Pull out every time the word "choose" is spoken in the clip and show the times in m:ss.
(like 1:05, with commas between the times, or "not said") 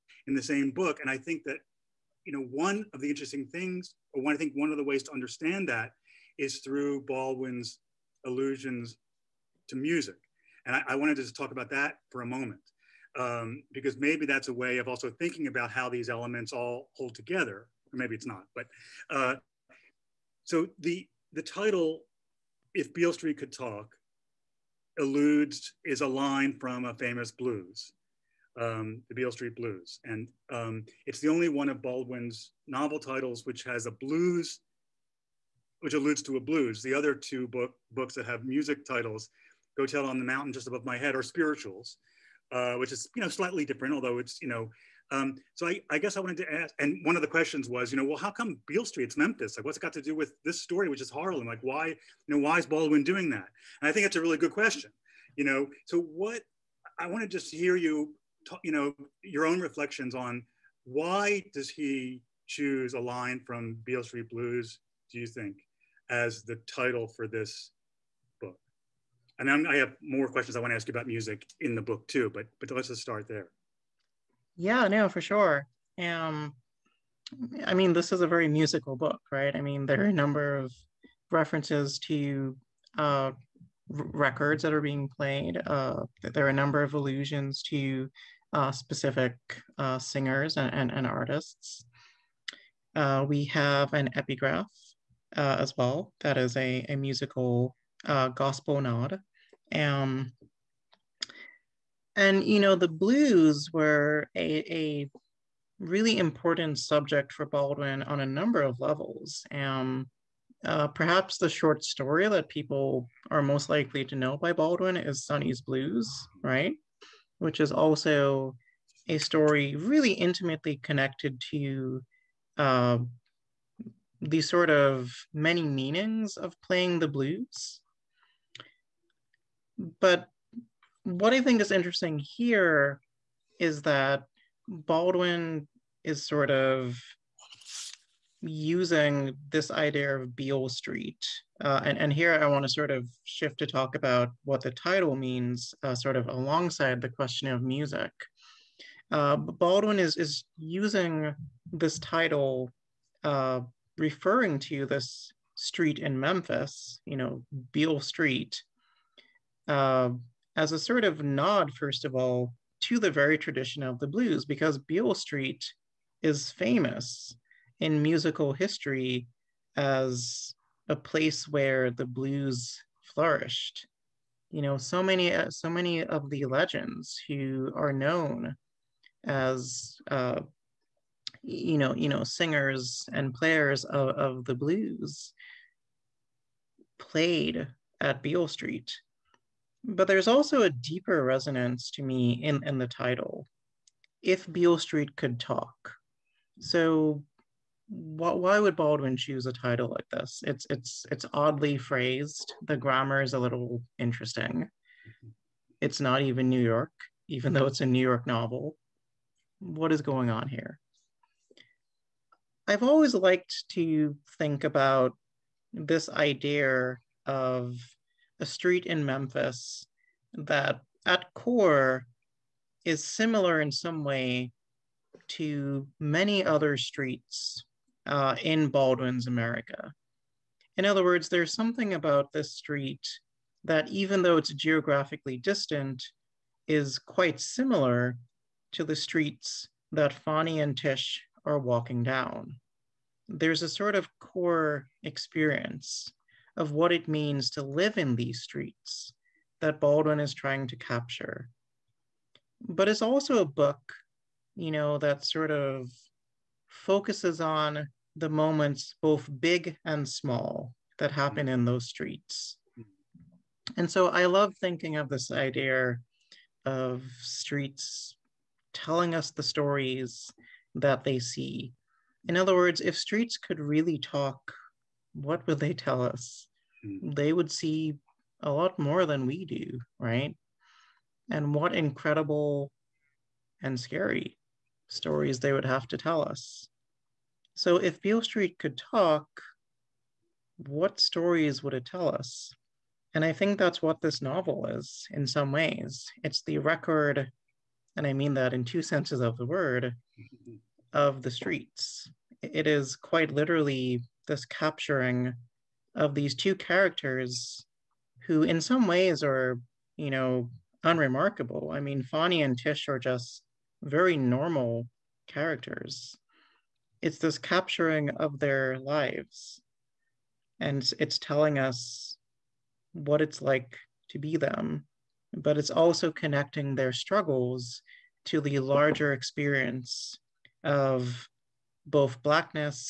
1:02, 3:19.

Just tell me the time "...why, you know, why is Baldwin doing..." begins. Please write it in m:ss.
0:51.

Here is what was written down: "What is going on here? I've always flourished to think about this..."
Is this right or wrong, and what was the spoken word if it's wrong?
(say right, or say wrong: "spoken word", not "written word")
wrong: "liked", not "flourished".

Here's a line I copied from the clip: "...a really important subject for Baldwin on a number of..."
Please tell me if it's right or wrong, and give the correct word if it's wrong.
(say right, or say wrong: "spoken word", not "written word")
right.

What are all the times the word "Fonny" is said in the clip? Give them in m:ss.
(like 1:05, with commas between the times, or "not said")
4:00, 5:12.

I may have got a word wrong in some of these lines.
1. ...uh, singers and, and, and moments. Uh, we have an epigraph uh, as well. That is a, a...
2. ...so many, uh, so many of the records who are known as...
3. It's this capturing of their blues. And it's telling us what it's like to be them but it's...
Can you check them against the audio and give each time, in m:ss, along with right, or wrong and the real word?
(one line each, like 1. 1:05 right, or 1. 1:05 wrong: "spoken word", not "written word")
1. 1:29 wrong: "artists", not "moments"
2. 2:54 wrong: "legends", not "records"
3. 5:17 wrong: "lives", not "blues".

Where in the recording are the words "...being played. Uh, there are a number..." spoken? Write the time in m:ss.
1:24.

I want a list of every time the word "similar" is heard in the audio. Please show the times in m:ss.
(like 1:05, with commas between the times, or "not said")
3:43, 3:57.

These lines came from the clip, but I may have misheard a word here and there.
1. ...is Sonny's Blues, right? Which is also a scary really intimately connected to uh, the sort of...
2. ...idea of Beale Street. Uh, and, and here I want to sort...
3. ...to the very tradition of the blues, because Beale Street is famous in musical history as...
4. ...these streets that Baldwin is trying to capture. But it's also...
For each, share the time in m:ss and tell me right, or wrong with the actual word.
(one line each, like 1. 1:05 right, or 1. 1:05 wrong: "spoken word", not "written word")
1. 1:54 wrong: "story", not "scary"
2. 2:19 right
3. 2:42 right
4. 4:08 right.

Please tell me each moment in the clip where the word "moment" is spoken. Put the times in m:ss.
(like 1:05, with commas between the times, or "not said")
0:12, 4:18.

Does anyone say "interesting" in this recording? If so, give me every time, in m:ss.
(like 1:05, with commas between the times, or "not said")
0:03, 2:11, 3:23.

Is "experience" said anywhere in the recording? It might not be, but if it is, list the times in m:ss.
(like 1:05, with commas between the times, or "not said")
4:05, 5:29.